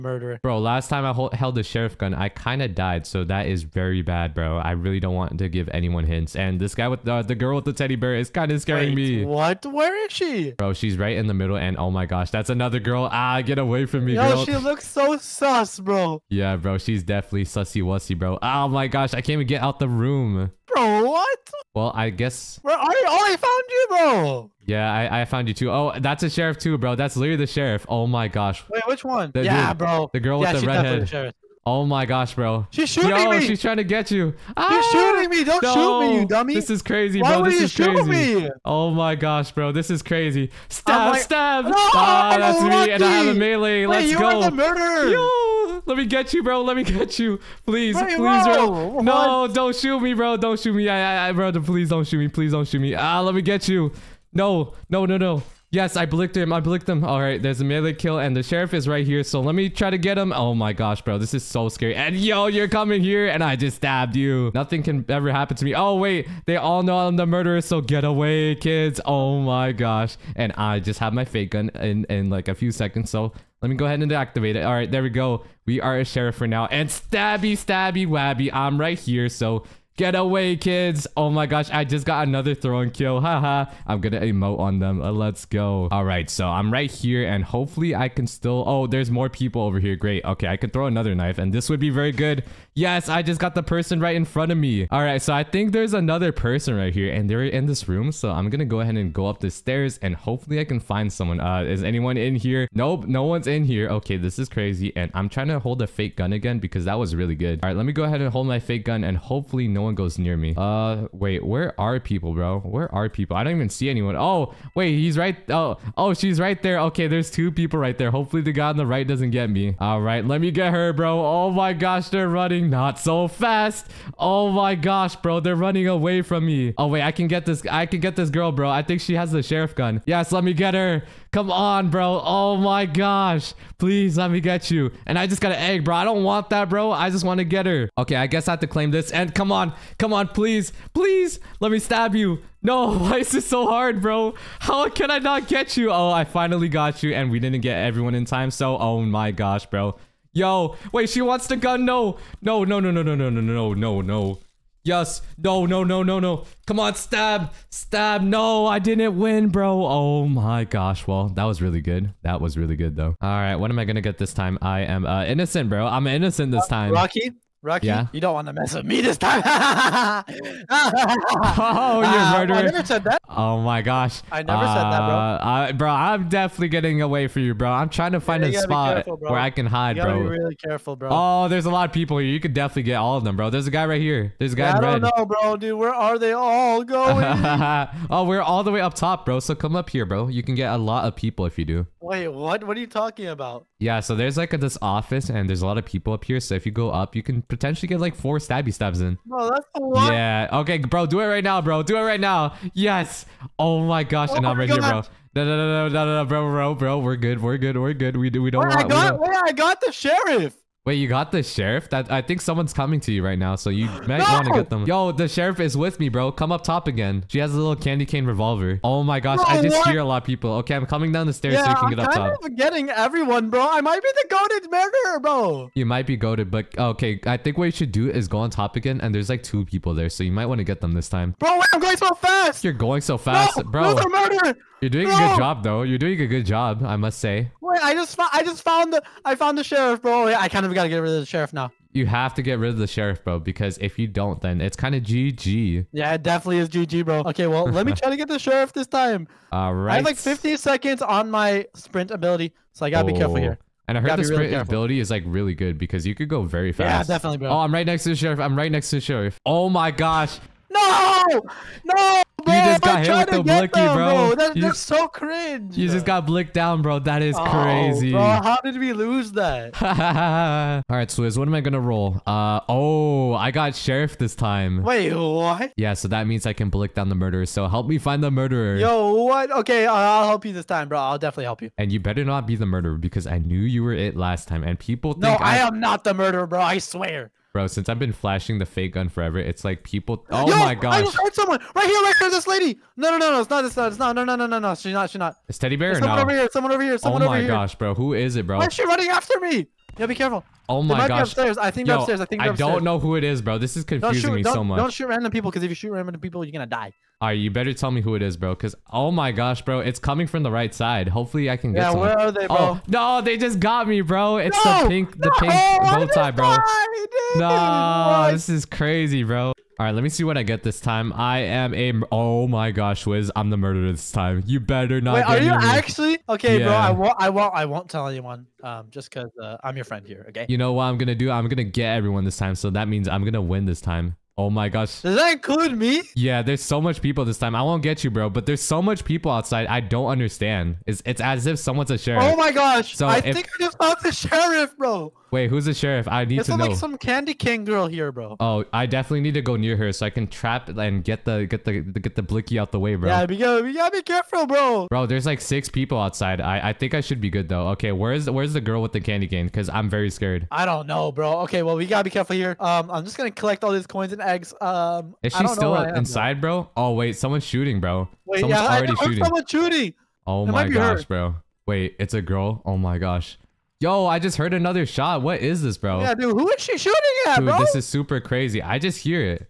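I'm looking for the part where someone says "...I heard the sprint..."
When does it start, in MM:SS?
04:13.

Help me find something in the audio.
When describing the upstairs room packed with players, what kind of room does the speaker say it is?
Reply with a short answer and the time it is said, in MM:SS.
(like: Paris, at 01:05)
office, at 03:14.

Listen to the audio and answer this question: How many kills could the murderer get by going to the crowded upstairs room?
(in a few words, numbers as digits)
4.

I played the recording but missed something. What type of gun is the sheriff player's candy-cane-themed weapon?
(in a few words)
revolver.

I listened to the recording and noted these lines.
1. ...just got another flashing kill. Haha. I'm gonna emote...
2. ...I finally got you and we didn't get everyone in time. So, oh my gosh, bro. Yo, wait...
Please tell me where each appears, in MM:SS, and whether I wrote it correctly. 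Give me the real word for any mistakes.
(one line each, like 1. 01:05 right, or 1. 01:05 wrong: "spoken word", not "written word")
1. 01:21 wrong: "throwing", not "flashing"
2. 02:26 right.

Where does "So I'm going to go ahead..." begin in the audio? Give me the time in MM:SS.
01:38.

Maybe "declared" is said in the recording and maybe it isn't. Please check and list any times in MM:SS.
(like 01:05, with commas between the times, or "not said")
not said.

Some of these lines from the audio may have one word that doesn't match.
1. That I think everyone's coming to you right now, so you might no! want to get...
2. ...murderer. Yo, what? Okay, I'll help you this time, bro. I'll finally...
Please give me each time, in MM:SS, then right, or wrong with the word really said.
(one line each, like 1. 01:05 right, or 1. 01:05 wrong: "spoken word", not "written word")
1. 03:31 wrong: "someone", not "everyone"
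2. 04:38 wrong: "definitely", not "finally".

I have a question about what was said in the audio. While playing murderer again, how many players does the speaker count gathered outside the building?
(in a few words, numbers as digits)
6.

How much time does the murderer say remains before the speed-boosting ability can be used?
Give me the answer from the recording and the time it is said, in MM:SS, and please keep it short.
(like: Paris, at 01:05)
50 seconds, at 04:10.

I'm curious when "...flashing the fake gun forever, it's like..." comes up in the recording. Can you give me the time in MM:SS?
04:48.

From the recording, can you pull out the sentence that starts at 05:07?
All right, you better tell me who it is, bro.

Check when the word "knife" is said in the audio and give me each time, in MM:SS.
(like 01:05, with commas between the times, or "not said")
01:31.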